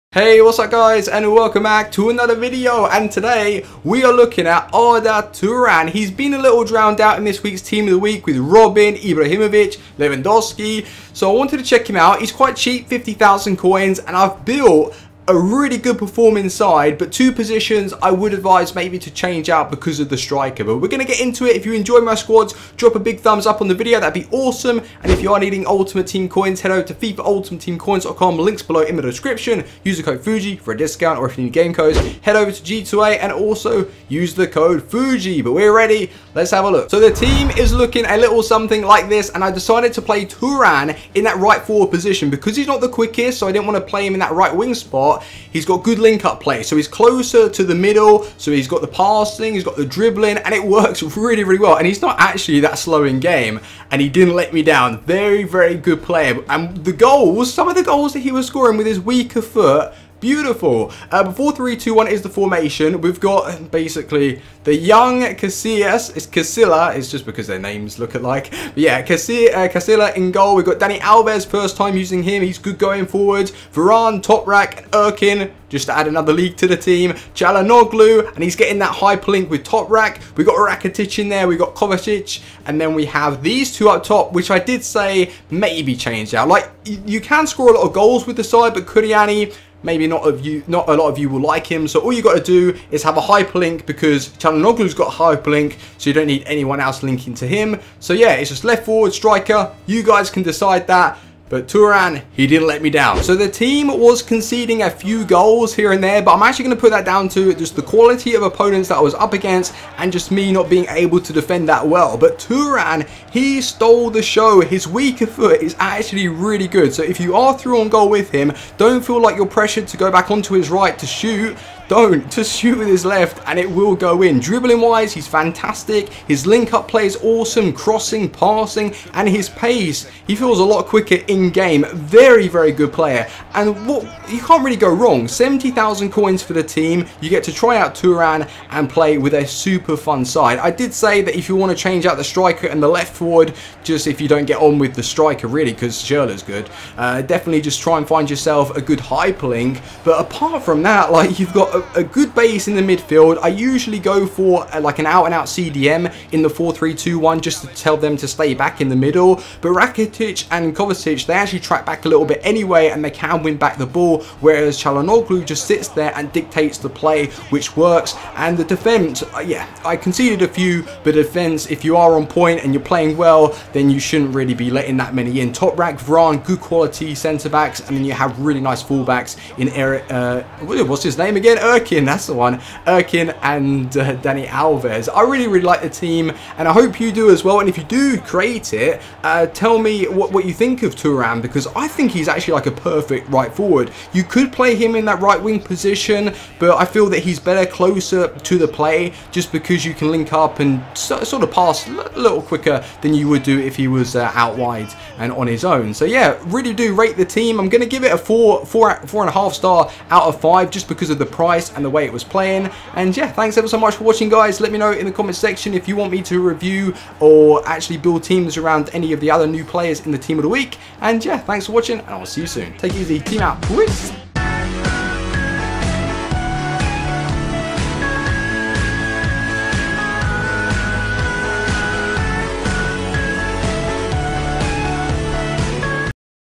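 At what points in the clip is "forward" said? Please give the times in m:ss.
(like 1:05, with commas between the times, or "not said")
0:41, 1:13, 1:38, 2:23, 3:13.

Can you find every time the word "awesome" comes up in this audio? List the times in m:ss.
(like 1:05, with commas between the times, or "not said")
0:24, 2:07.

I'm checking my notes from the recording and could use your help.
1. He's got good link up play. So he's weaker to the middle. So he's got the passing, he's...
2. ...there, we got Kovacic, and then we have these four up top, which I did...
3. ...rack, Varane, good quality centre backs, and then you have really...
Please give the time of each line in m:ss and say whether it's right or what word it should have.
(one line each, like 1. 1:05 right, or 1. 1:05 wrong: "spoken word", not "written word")
1. 0:45 wrong: "closer", not "weaker"
2. 1:21 wrong: "two", not "four"
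3. 2:55 right.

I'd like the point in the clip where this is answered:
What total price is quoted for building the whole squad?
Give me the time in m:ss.
2:15.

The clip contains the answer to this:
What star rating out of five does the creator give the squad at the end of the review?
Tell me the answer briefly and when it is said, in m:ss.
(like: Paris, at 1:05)
4.5 stars, at 3:29.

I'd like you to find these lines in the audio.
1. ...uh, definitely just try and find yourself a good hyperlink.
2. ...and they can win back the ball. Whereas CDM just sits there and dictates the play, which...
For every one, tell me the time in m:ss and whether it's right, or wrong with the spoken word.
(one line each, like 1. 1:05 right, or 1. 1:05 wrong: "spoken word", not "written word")
1. 2:26 right
2. 2:42 wrong: "Calhanoglu", not "CDM".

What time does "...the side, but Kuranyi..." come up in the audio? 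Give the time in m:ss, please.
1:28.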